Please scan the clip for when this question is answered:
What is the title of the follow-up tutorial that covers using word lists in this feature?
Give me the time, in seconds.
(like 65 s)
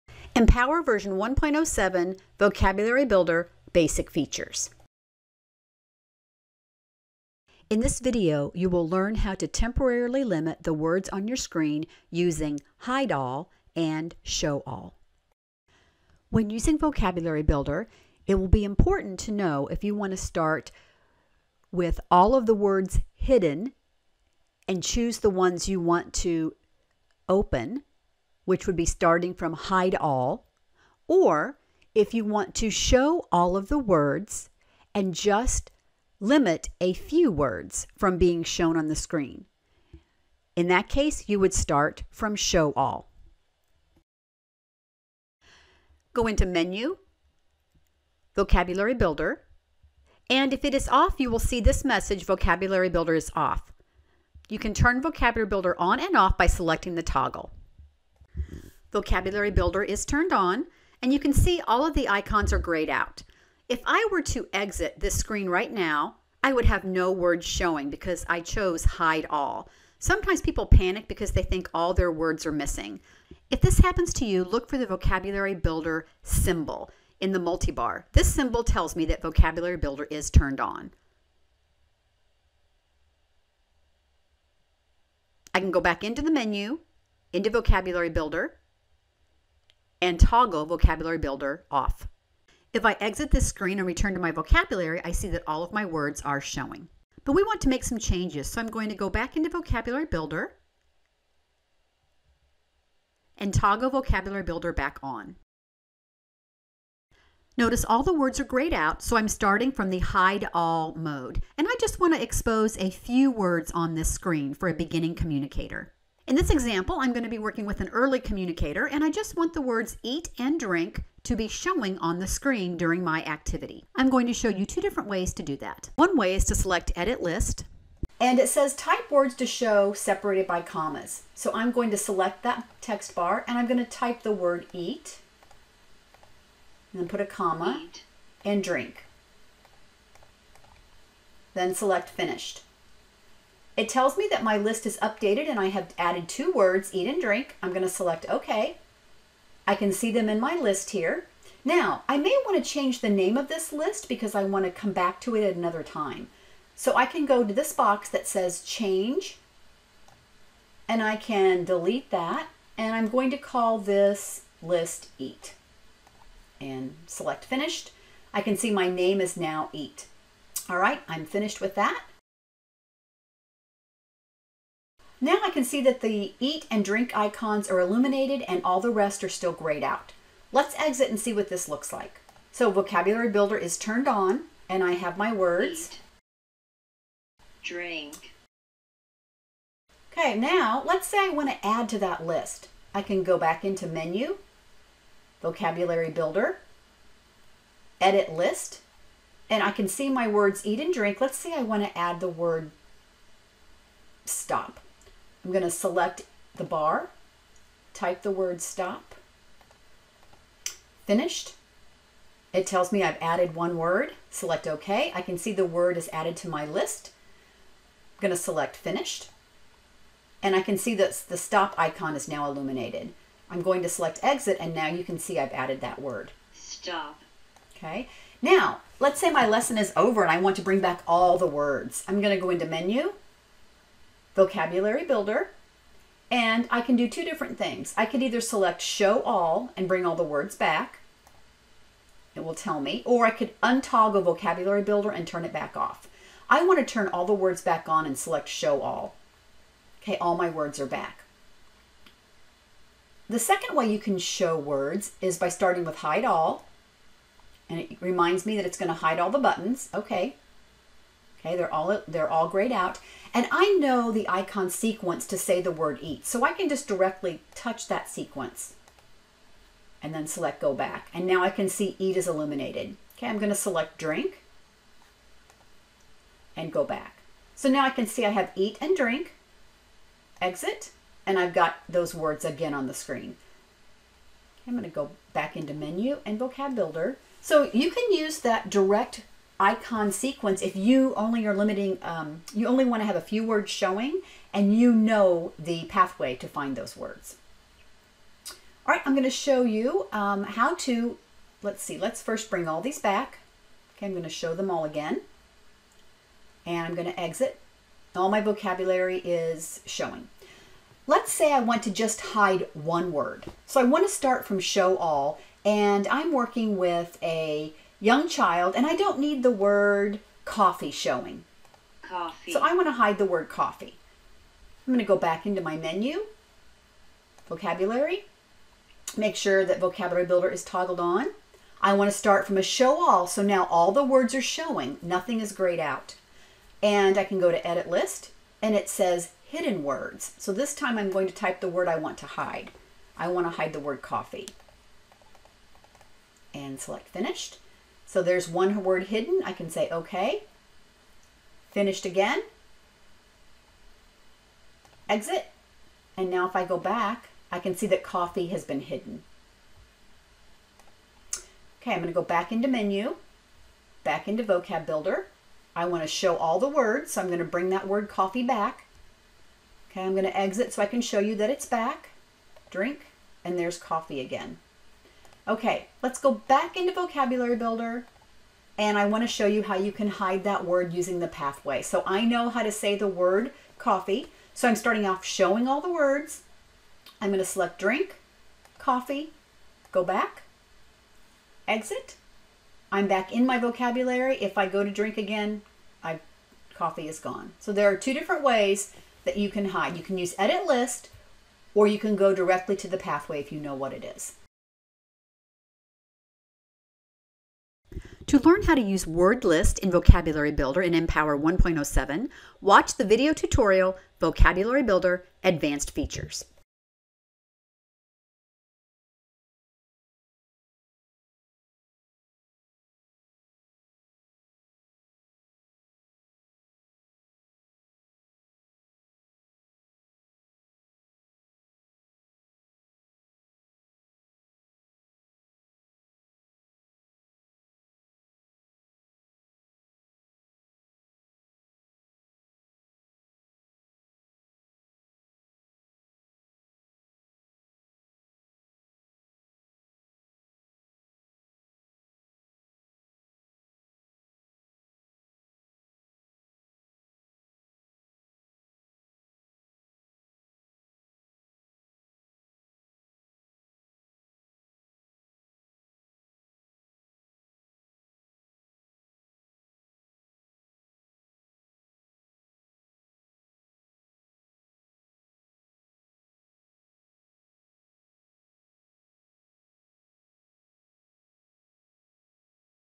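414 s.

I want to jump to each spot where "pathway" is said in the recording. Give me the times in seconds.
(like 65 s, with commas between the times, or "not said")
295 s, 381 s, 402 s.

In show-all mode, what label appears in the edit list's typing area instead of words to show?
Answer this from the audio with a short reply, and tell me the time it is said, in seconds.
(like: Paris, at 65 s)
hidden words, at 339 s.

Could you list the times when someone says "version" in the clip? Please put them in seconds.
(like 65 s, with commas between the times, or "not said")
0 s.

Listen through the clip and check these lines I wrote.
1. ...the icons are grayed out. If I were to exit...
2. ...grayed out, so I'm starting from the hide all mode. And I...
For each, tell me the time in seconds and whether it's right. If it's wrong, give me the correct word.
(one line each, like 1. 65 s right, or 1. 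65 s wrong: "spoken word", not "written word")
1. 61 s right
2. 108 s right.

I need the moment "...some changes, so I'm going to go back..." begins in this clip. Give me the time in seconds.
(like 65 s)
97 s.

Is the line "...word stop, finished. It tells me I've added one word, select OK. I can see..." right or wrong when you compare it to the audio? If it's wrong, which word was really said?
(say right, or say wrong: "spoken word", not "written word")
right.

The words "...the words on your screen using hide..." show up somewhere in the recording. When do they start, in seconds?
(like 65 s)
10 s.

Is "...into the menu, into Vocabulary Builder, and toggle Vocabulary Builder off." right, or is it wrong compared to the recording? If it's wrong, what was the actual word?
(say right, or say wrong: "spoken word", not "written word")
right.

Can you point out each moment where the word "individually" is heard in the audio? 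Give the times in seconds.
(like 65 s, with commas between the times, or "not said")
not said.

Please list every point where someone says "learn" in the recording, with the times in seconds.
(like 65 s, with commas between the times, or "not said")
8 s, 408 s.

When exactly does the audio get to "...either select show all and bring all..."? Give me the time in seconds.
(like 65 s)
238 s.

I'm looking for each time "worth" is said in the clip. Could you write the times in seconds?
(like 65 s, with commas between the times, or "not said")
not said.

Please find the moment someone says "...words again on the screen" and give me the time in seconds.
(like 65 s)
282 s.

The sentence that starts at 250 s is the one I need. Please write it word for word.
Okay, all my words are back.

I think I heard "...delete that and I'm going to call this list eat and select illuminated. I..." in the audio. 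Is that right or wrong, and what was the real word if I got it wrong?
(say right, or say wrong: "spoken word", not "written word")
wrong: "finished", not "illuminated".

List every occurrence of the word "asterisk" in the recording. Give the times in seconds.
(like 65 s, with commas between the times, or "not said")
not said.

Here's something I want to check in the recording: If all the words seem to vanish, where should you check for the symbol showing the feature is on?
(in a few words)
the multibar.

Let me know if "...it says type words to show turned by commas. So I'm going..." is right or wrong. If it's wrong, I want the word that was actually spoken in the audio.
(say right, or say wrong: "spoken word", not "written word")
wrong: "separated", not "turned".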